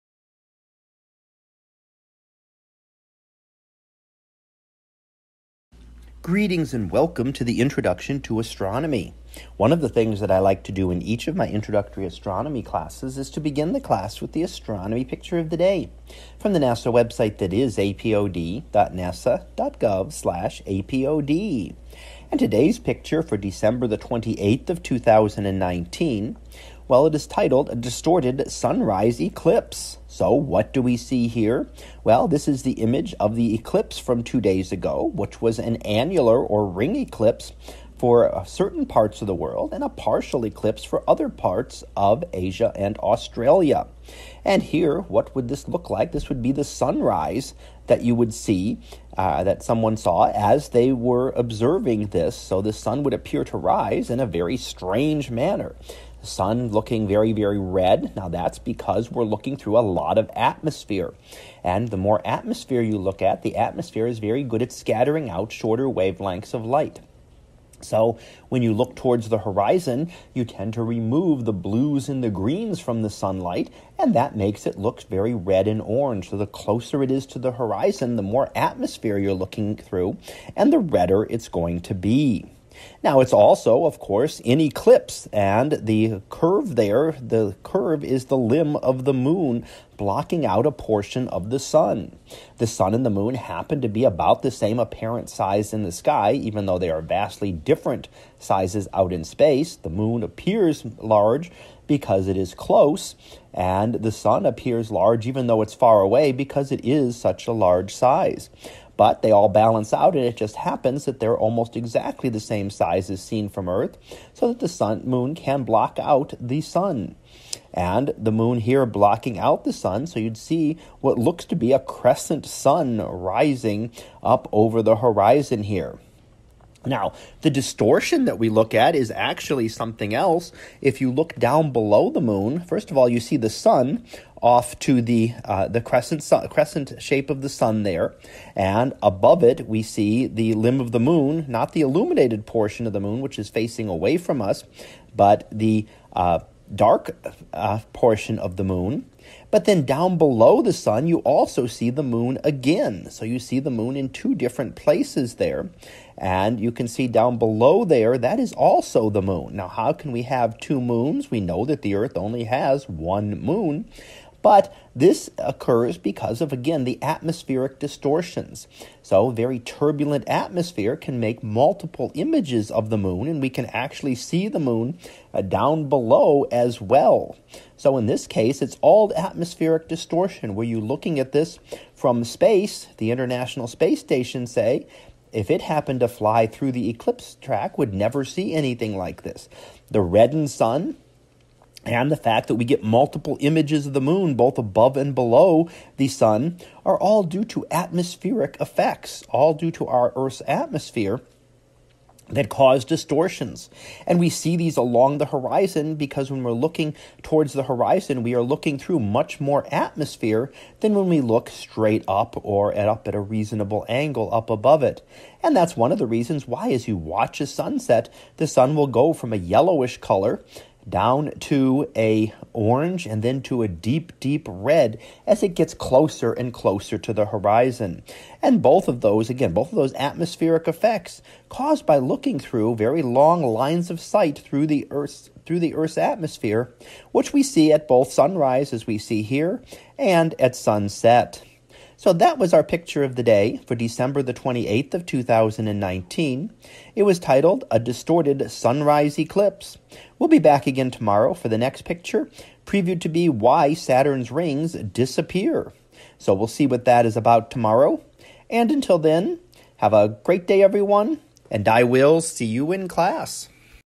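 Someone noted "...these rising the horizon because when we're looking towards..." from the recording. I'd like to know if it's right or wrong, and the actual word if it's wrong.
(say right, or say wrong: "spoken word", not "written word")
wrong: "along", not "rising".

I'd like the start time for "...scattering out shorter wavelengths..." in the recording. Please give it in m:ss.
1:04.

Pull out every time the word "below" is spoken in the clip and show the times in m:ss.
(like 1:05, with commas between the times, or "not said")
2:11, 2:30, 2:37, 2:55, 3:15.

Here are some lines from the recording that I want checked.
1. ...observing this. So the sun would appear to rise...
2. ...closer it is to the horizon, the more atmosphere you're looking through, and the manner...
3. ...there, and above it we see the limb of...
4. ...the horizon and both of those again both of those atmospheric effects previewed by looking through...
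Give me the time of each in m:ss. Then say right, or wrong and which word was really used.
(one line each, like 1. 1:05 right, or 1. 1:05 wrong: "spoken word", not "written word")
1. 0:51 right
2. 1:16 wrong: "redder", not "manner"
3. 2:17 right
4. 3:47 wrong: "caused", not "previewed".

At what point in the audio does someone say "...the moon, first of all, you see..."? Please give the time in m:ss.
2:12.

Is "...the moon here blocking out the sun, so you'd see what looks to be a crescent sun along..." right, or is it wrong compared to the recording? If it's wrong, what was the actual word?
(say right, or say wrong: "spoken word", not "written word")
wrong: "rising", not "along".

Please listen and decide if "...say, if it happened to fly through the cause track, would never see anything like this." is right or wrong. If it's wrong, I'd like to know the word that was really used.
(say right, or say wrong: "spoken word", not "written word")
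wrong: "eclipse", not "cause".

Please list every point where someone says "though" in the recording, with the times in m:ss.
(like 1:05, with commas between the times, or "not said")
1:36, 1:45.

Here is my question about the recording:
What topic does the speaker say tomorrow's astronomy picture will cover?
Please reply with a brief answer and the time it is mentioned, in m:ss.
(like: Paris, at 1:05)
Why Saturn's Rings Disappear, at 4:13.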